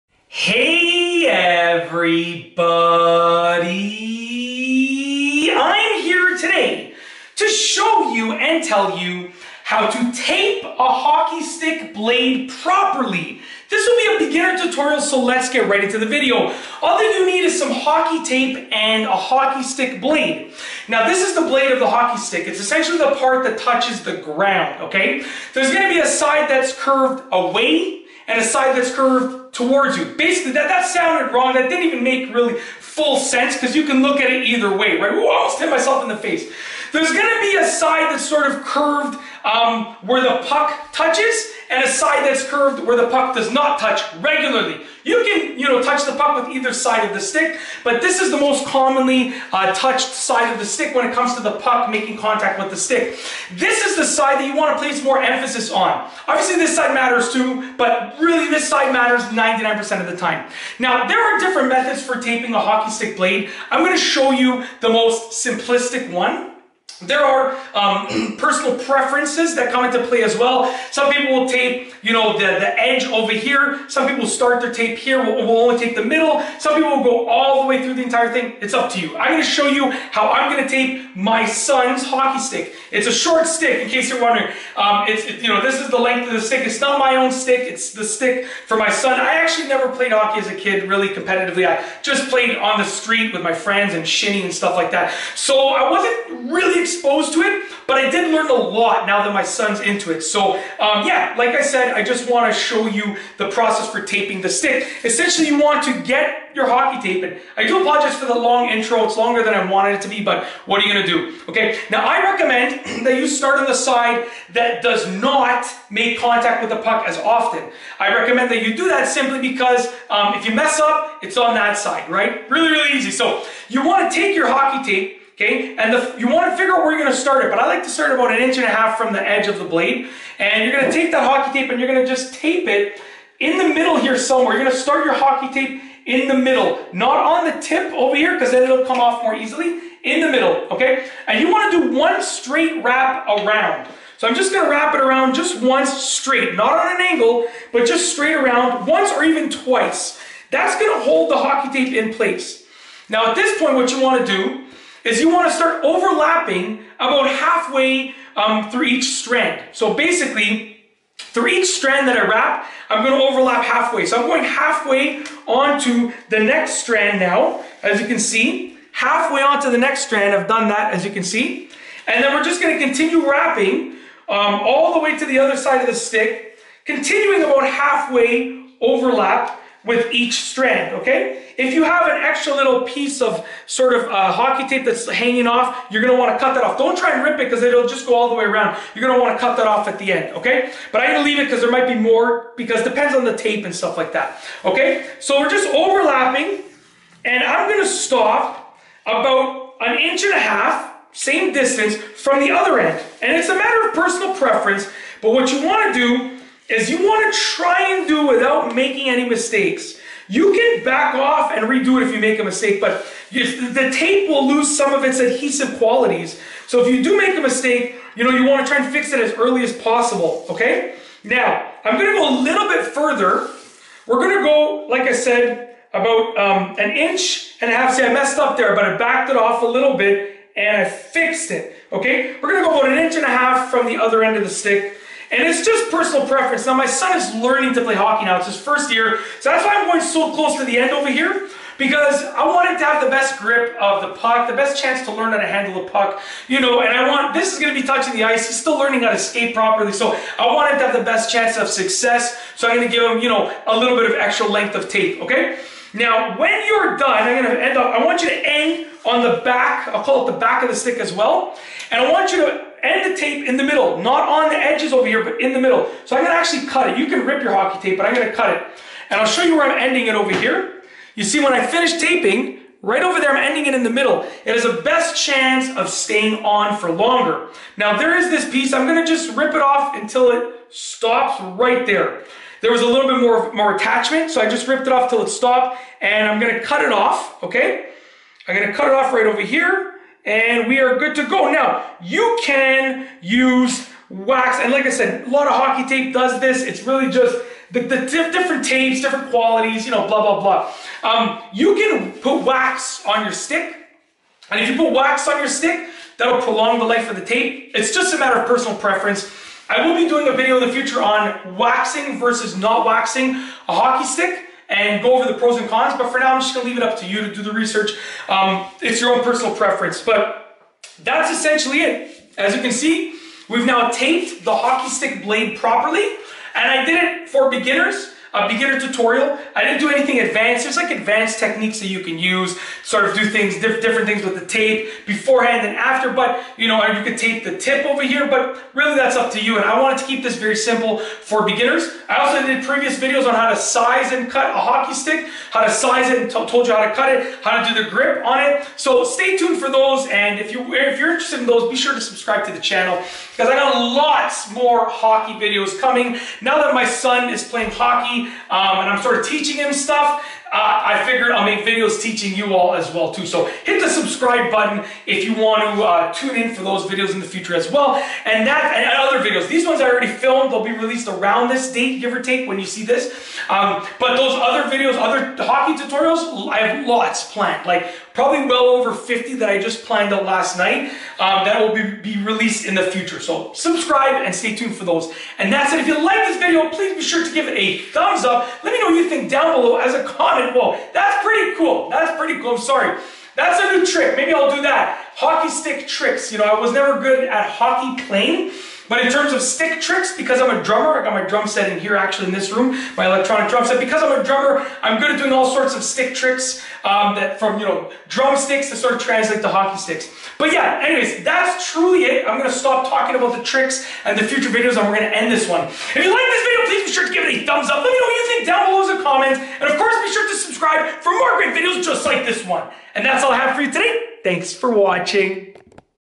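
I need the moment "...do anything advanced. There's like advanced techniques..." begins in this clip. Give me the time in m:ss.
5:29.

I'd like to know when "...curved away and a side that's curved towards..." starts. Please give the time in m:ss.
0:26.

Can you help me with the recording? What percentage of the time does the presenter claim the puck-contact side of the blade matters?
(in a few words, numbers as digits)
99%.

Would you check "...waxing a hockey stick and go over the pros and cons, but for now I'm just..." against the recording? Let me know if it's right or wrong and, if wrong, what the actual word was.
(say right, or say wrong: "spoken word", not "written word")
right.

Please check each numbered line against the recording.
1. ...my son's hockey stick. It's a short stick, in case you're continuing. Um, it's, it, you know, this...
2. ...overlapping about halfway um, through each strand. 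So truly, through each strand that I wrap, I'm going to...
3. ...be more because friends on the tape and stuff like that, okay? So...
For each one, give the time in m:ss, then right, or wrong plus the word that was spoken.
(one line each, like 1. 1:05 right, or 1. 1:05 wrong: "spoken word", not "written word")
1. 1:21 wrong: "wondering", not "continuing"
2. 2:35 wrong: "basically", not "truly"
3. 3:11 wrong: "depends", not "friends".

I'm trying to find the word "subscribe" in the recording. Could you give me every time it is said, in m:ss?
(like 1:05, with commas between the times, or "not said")
5:52, 6:03, 6:23, 7:00.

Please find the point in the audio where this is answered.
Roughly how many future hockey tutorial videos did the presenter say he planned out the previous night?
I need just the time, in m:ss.
6:18.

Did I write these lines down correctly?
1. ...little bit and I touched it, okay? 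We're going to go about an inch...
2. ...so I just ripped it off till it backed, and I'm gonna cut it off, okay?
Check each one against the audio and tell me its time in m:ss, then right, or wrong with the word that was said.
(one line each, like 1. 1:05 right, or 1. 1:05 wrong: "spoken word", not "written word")
1. 3:49 wrong: "fixed", not "touched"
2. 4:44 wrong: "stopped", not "backed".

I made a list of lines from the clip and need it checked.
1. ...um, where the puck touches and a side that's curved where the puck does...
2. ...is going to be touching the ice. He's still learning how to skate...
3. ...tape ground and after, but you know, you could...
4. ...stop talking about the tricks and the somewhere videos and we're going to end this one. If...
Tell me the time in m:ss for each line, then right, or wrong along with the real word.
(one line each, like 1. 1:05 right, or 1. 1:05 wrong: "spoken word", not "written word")
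1. 0:39 right
2. 4:07 right
3. 5:34 wrong: "beforehand", not "ground"
4. 6:52 wrong: "future", not "somewhere".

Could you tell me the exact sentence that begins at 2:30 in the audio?
That's going to hold the hockey tape in place.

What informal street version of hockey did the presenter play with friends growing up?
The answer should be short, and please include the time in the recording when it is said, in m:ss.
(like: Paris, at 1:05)
shinny, at 1:34.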